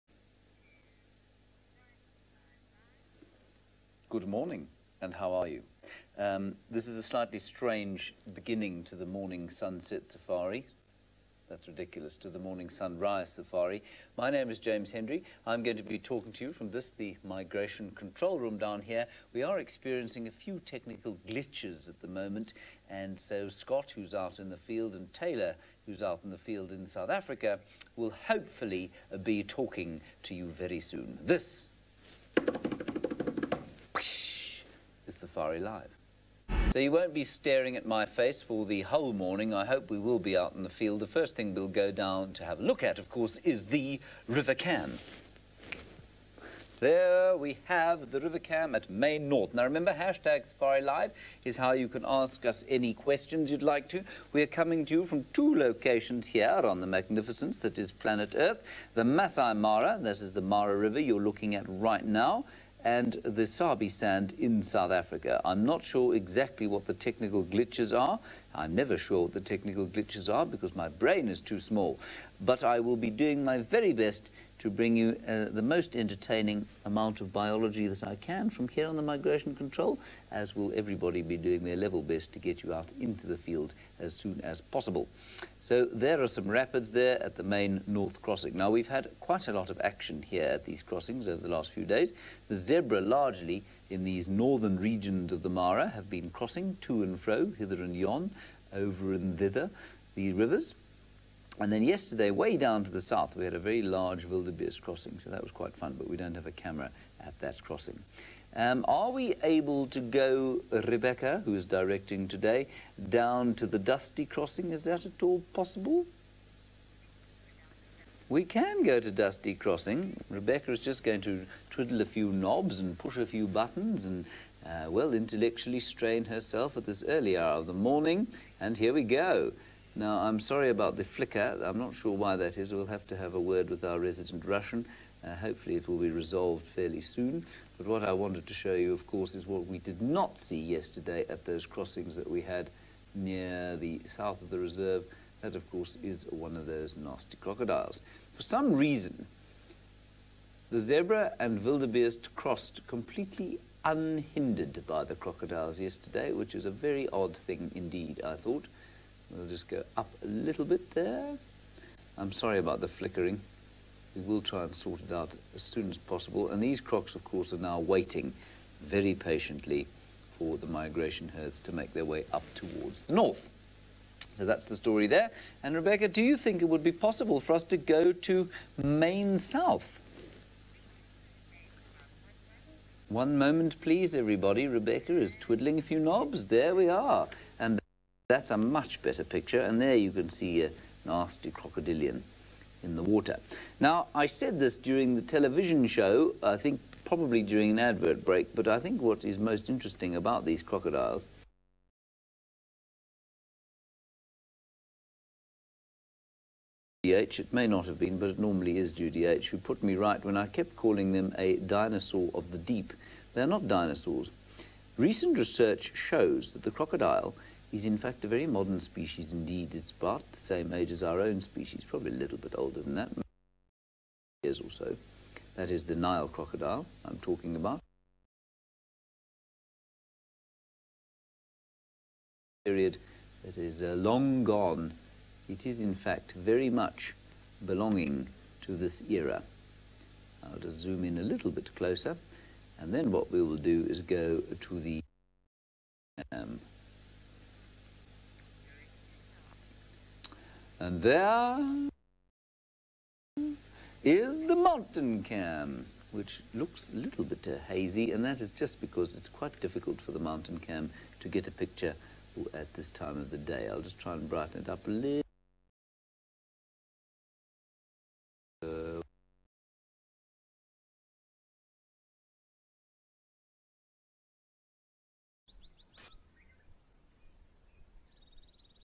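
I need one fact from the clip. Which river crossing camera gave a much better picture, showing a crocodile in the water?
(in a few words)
Main South.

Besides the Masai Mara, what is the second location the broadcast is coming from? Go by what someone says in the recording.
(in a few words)
Sabi Sand.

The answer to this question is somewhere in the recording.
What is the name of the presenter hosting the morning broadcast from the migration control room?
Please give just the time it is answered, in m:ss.
0:14.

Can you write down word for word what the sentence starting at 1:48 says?
Um, are we able to go, Rebecca, who's directing today, down to the Dusty Crossing?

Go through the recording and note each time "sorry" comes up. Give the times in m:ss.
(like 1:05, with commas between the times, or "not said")
2:10, 2:42.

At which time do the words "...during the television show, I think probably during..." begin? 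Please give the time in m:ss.
3:14.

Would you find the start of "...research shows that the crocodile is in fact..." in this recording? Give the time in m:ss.
3:35.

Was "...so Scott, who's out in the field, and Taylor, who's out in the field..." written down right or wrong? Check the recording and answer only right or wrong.
right.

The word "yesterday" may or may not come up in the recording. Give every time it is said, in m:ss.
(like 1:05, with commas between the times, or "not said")
1:41, 2:20, 2:35.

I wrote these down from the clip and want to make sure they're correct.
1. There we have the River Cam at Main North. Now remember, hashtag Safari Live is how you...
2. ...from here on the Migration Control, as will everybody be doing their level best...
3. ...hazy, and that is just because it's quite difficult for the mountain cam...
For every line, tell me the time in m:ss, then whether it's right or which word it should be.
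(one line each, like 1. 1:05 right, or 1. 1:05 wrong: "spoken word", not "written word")
1. 0:46 right
2. 1:18 right
3. 4:17 right.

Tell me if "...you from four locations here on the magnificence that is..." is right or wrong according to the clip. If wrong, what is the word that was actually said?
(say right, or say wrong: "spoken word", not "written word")
wrong: "two", not "four".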